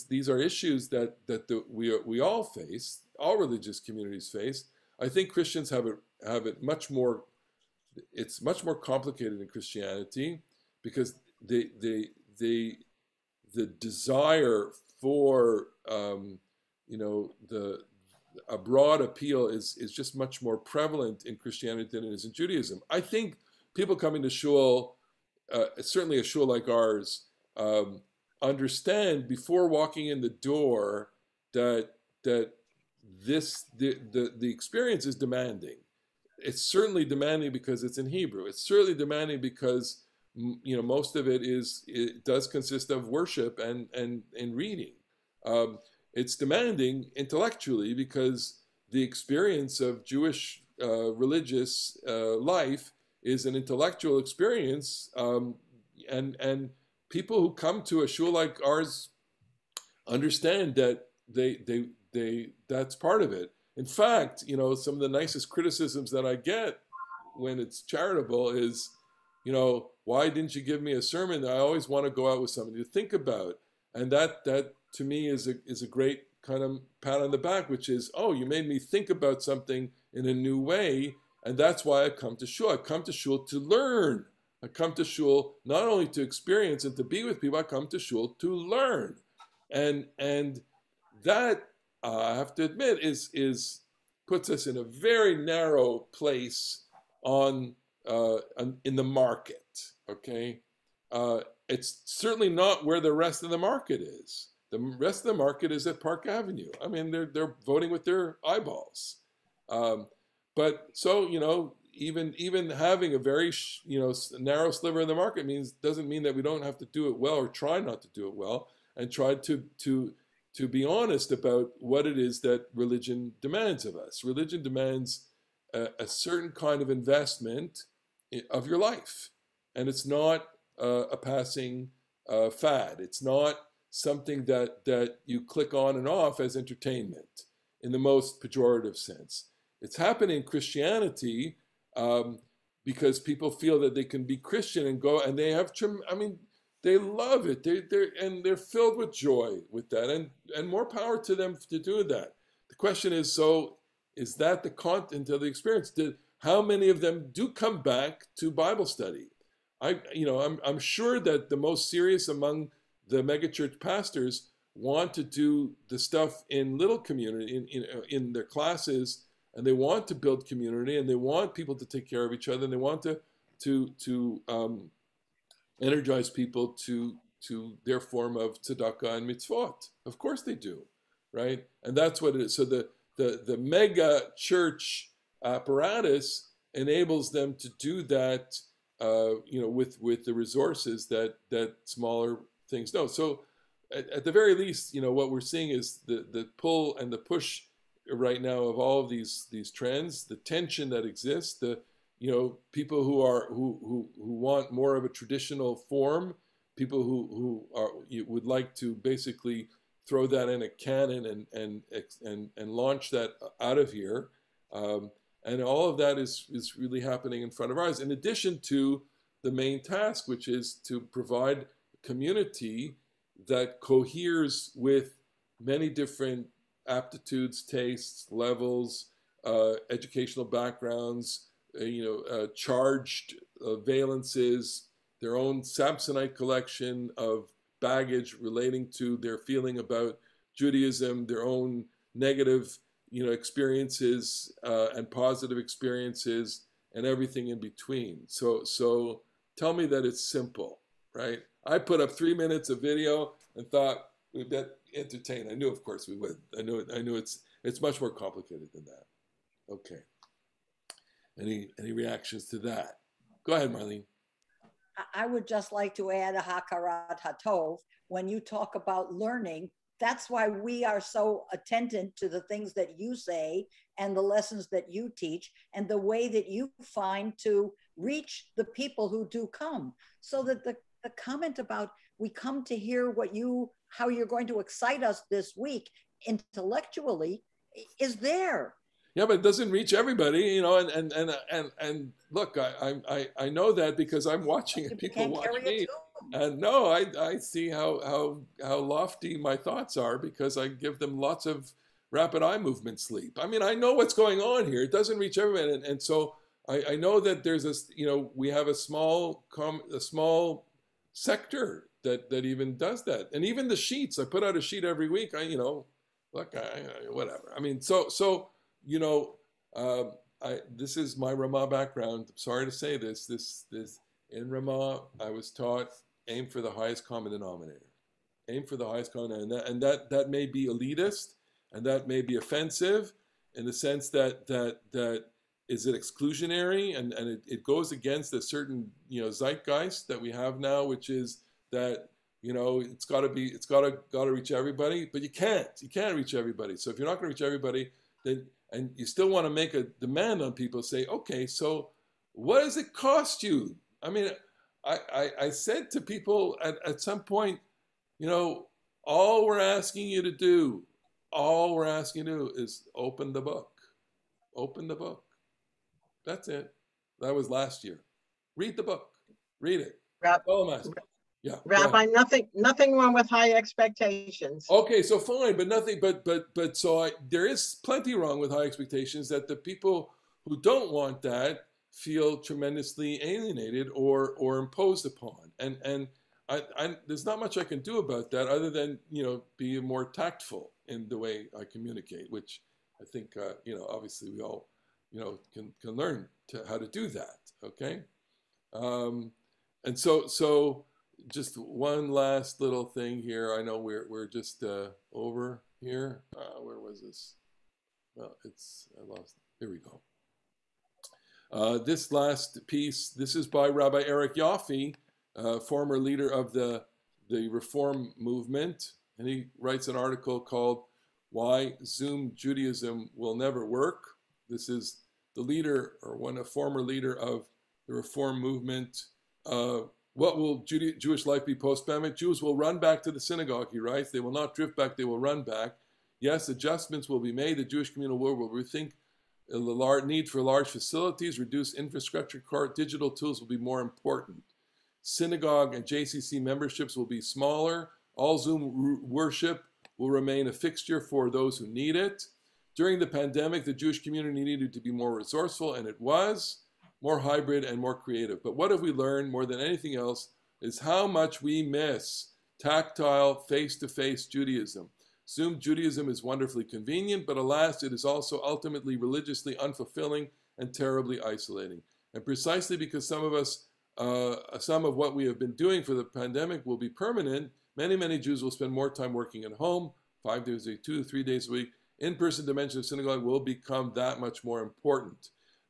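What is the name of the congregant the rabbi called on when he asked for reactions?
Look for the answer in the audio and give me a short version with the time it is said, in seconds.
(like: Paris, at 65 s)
Marlene, at 263 s.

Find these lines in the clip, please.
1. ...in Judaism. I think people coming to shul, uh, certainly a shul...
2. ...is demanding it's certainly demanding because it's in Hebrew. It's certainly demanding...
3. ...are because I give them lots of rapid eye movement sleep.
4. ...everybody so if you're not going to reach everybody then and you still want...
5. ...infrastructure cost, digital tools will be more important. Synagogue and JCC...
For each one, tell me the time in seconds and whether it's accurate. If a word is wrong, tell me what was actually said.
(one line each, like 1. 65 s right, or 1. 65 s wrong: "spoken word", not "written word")
1. 22 s right
2. 35 s right
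3. 299 s right
4. 346 s right
5. 441 s right.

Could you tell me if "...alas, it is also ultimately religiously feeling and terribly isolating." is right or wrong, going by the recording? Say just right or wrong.
wrong.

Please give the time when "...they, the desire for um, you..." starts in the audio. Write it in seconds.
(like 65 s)
12 s.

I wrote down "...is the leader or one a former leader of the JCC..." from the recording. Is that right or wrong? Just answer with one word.
wrong.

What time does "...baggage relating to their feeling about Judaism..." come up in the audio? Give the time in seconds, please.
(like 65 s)
237 s.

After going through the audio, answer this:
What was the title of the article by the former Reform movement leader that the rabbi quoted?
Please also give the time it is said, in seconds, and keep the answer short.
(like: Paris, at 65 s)
Why Zoom Judaism Will Never Work, at 421 s.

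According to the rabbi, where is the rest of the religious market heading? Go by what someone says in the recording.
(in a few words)
Park Avenue.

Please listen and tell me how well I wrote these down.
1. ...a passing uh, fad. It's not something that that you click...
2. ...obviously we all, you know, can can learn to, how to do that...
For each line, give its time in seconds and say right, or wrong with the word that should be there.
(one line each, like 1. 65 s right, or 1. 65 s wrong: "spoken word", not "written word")
1. 131 s right
2. 393 s right.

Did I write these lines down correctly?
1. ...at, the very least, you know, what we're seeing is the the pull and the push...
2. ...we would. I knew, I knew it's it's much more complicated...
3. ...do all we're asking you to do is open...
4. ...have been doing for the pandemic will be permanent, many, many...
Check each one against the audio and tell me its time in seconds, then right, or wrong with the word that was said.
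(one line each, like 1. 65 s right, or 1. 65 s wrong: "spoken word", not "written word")
1. 194 s right
2. 256 s right
3. 360 s right
4. 475 s right.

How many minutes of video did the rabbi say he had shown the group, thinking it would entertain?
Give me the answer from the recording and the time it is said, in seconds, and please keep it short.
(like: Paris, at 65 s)
3, at 252 s.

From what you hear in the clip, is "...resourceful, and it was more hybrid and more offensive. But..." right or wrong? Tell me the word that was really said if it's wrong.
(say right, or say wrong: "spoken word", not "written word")
wrong: "creative", not "offensive".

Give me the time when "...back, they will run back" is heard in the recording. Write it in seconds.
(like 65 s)
434 s.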